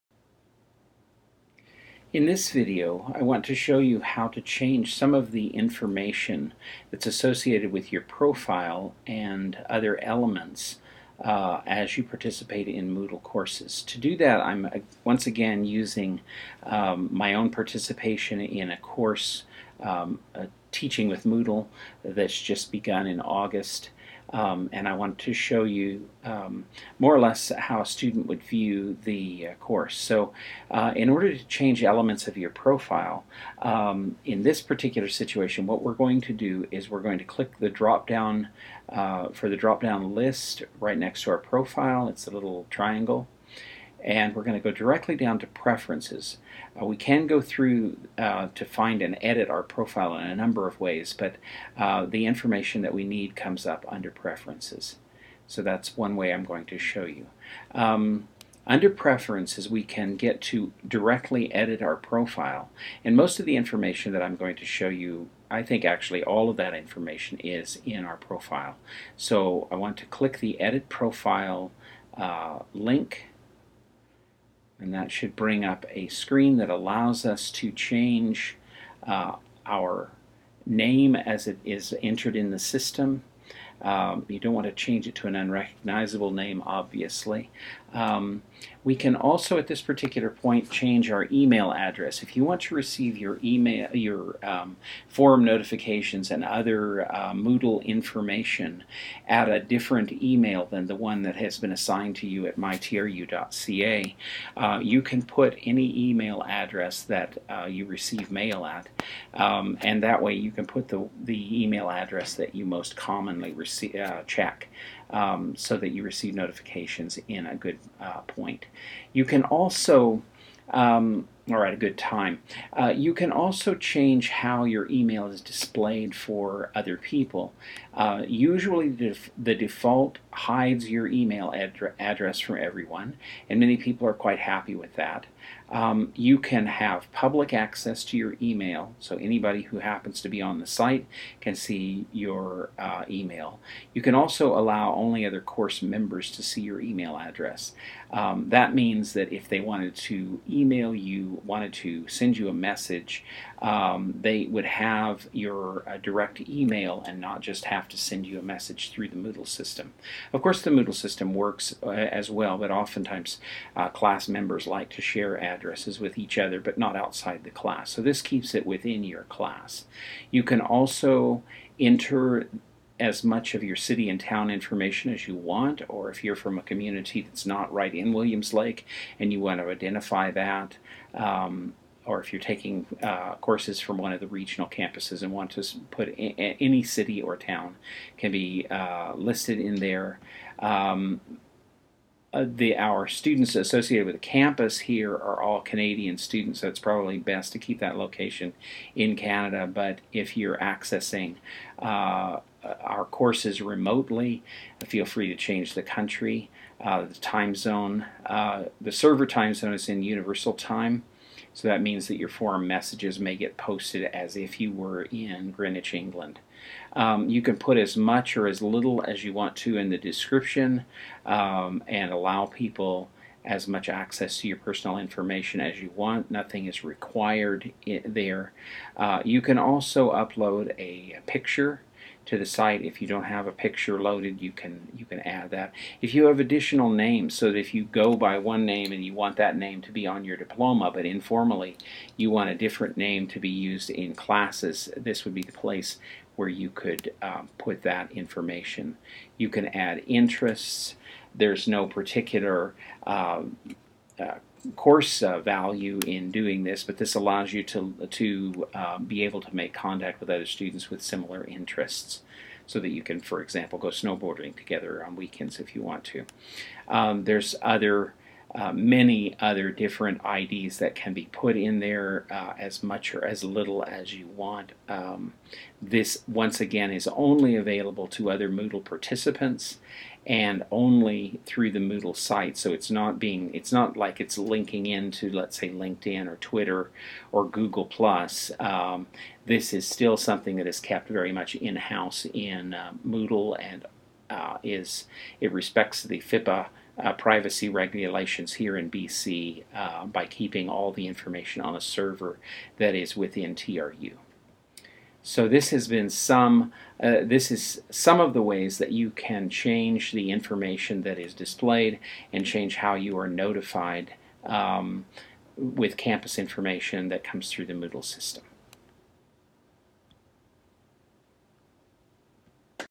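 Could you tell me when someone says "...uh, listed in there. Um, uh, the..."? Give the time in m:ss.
3:08.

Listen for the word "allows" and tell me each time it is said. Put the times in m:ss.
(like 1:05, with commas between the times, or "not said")
1:16, 2:24, 3:42, 4:17.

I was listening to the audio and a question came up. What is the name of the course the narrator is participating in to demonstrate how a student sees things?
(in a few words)
Teaching with Moodle.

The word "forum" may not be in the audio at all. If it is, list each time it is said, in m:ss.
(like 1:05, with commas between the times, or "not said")
1:35, 3:32.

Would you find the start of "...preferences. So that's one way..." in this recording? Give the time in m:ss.
0:54.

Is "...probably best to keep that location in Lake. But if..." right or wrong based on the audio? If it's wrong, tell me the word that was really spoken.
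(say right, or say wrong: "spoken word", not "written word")
wrong: "Canada", not "Lake".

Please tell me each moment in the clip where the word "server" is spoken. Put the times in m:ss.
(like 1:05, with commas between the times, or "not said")
3:28, 5:01.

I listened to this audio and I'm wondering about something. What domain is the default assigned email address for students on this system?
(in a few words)
mytru.ca.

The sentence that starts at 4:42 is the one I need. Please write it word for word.
So it's not being, it's not like it's linking into, let's say, LinkedIn or Twitter or Google Plus.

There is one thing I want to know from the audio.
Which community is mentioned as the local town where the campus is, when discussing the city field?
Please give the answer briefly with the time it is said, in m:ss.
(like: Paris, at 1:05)
Williams Lake, at 2:58.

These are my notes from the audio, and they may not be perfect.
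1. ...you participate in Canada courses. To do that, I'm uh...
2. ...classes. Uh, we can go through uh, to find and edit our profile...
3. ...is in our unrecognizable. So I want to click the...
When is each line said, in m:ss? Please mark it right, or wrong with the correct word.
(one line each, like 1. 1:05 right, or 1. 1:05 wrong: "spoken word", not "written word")
1. 0:11 wrong: "Moodle", not "Canada"
2. 0:45 wrong: "preferences", not "classes"
3. 1:07 wrong: "profile", not "unrecognizable".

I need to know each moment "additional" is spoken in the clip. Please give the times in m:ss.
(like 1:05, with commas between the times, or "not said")
3:56.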